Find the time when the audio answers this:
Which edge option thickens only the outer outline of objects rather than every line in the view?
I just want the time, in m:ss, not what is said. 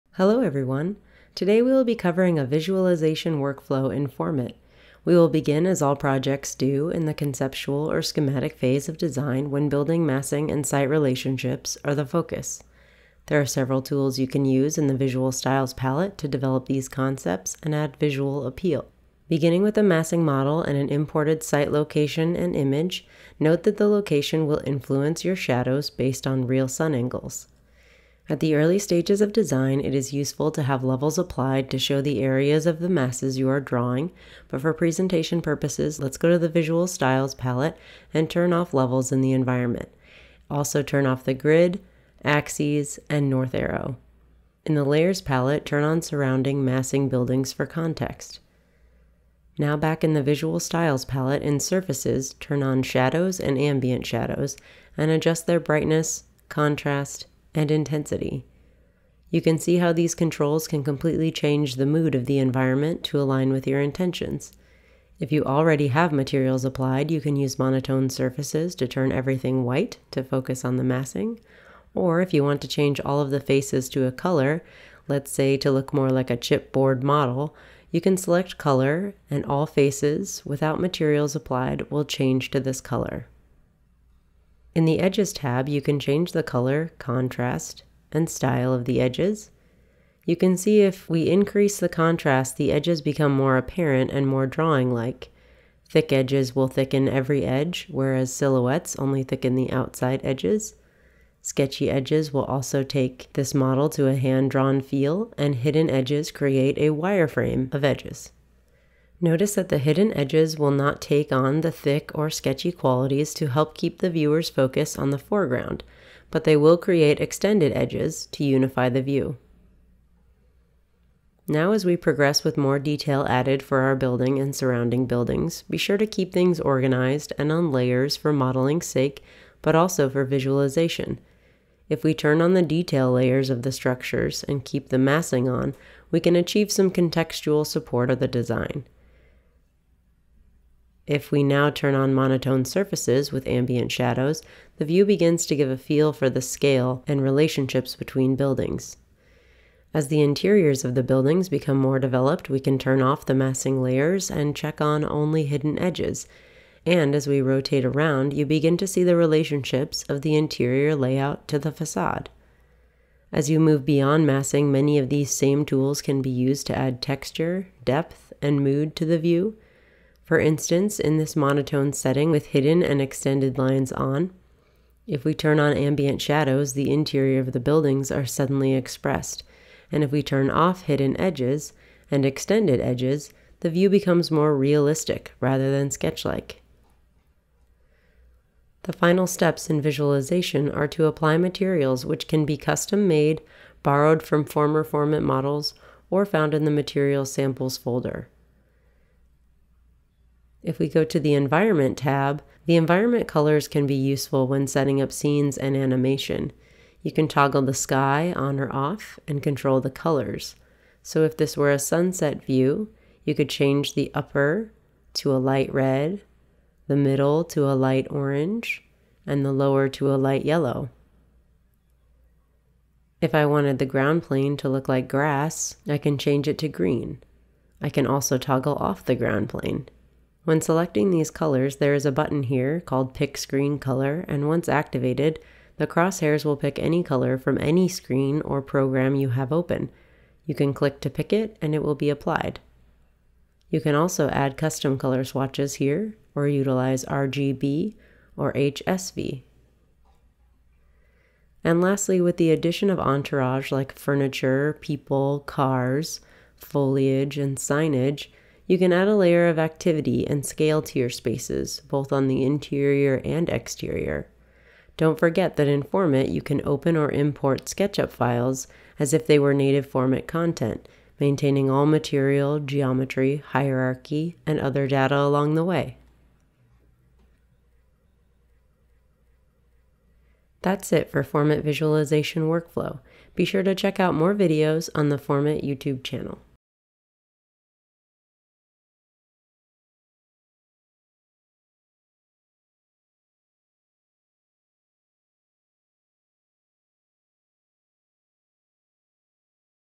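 1:38.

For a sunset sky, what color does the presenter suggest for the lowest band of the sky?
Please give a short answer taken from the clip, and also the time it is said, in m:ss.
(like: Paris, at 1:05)
light yellow, at 3:40.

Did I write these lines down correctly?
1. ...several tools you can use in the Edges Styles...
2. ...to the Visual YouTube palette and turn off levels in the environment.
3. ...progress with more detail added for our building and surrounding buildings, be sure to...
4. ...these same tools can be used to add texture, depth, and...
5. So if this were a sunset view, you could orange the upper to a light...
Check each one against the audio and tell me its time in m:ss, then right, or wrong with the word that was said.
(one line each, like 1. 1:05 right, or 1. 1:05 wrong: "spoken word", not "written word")
1. 0:13 wrong: "Visual", not "Edges"
2. 0:36 wrong: "Styles", not "YouTube"
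3. 2:01 right
4. 2:45 right
5. 3:31 wrong: "change", not "orange".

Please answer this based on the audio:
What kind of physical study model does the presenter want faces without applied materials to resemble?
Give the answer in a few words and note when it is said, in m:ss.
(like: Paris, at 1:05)
chipboard model, at 1:16.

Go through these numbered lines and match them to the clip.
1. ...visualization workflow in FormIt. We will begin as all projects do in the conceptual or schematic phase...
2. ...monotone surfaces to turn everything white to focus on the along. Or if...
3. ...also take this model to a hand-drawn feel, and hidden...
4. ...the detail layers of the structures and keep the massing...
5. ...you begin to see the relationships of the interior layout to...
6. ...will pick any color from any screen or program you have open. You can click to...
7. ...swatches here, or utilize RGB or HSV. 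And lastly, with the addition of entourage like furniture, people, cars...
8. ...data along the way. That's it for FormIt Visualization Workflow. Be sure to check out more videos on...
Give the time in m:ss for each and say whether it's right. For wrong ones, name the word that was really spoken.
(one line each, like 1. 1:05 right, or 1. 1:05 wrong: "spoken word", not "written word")
1. 0:02 right
2. 1:07 wrong: "massing", not "along"
3. 1:42 right
4. 2:12 right
5. 2:38 right
6. 3:56 right
7. 4:05 right
8. 4:34 right.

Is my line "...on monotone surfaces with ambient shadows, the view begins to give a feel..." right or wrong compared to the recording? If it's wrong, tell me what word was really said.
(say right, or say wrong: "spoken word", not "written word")
right.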